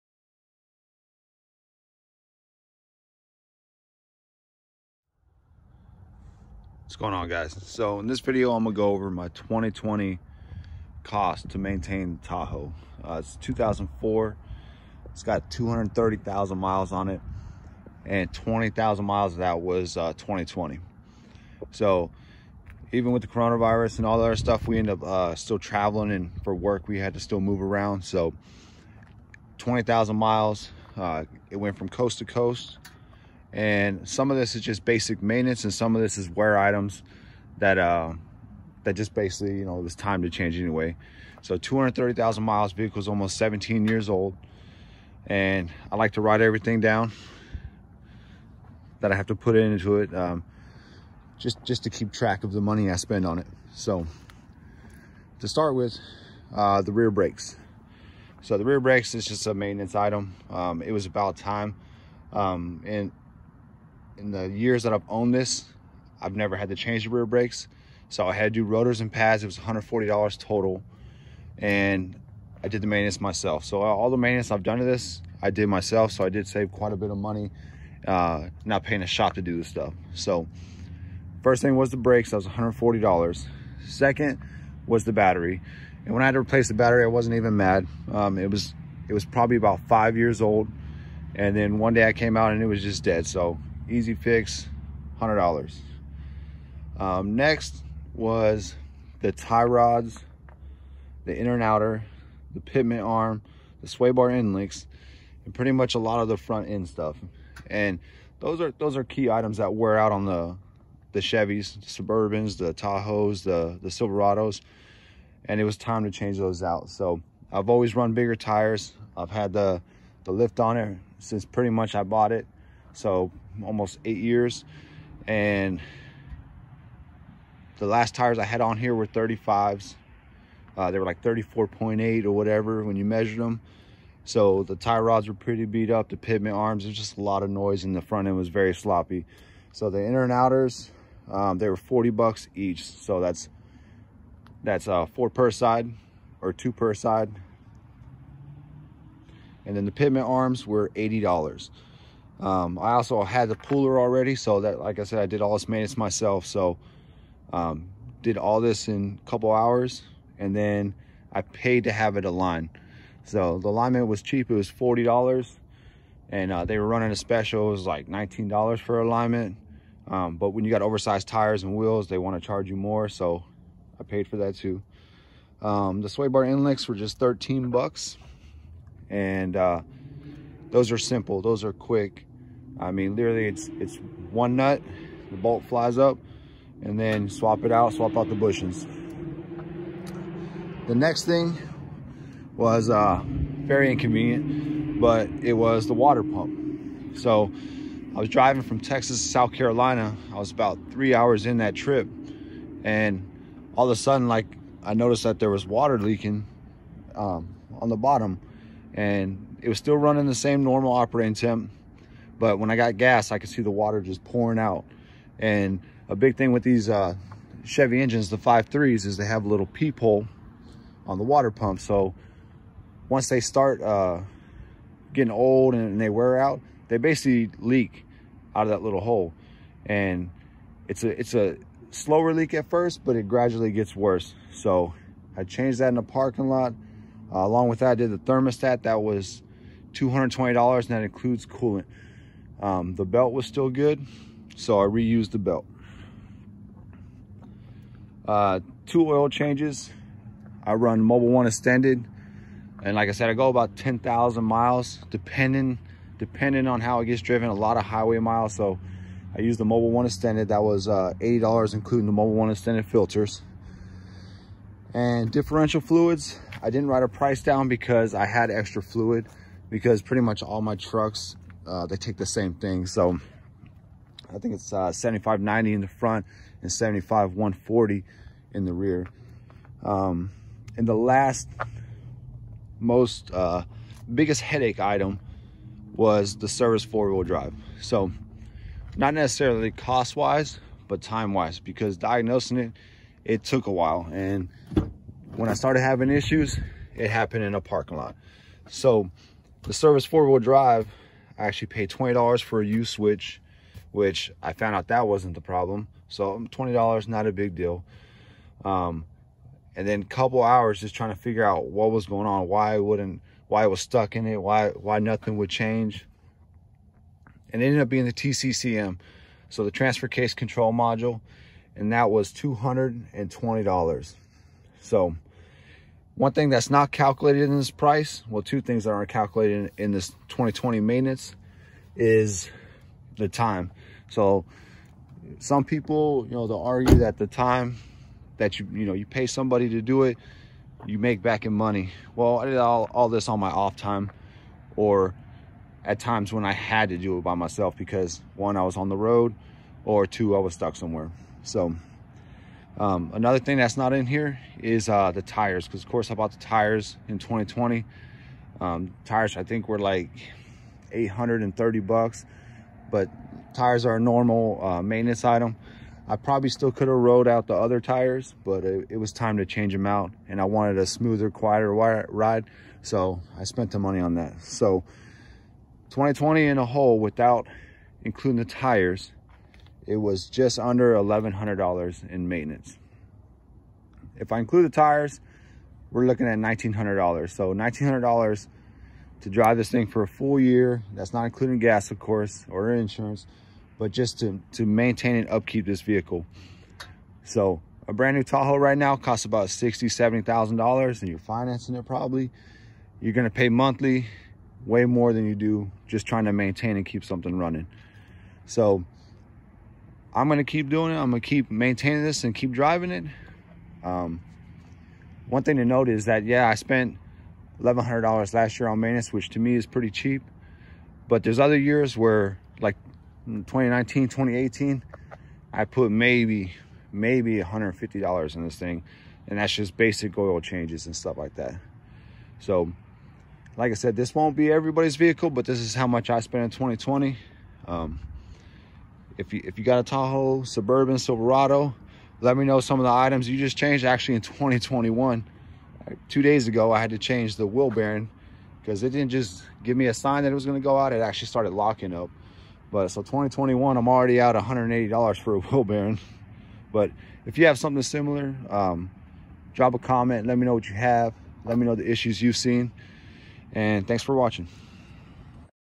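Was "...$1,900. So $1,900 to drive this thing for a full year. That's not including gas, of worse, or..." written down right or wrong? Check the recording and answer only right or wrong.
wrong.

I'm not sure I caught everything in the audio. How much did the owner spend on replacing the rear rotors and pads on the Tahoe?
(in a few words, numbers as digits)
$140.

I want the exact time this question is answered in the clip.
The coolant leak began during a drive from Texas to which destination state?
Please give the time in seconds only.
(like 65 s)
199 s.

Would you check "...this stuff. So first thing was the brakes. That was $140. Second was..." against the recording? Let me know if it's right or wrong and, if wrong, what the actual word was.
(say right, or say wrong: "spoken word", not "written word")
right.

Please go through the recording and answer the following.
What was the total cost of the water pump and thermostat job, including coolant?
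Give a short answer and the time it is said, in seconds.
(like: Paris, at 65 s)
$220, at 238 s.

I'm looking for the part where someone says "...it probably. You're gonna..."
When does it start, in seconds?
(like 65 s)
401 s.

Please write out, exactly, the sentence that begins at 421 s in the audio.
But there's other years where, like 2019, 2018, I put maybe, maybe $150 in this thing.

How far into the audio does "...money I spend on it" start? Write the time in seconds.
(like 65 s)
52 s.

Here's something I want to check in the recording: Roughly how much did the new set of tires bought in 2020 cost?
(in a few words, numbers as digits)
$830.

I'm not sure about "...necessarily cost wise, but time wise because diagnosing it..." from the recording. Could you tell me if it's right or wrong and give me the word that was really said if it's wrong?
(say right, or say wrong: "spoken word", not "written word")
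right.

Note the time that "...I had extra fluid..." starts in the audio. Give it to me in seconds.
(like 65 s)
268 s.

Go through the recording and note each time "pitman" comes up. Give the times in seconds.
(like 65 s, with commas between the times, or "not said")
102 s, 136 s, 149 s.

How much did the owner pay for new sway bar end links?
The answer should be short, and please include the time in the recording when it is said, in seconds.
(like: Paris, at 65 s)
$13, at 177 s.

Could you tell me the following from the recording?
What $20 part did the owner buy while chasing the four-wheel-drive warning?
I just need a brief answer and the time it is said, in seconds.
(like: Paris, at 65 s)
U switch, at 302 s.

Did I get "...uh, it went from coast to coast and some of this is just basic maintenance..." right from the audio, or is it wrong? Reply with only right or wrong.
right.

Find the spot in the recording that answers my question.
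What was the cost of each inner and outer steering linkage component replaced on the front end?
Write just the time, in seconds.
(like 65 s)
141 s.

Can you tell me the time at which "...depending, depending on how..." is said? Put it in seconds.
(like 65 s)
255 s.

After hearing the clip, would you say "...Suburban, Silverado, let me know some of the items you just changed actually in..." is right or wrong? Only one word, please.
right.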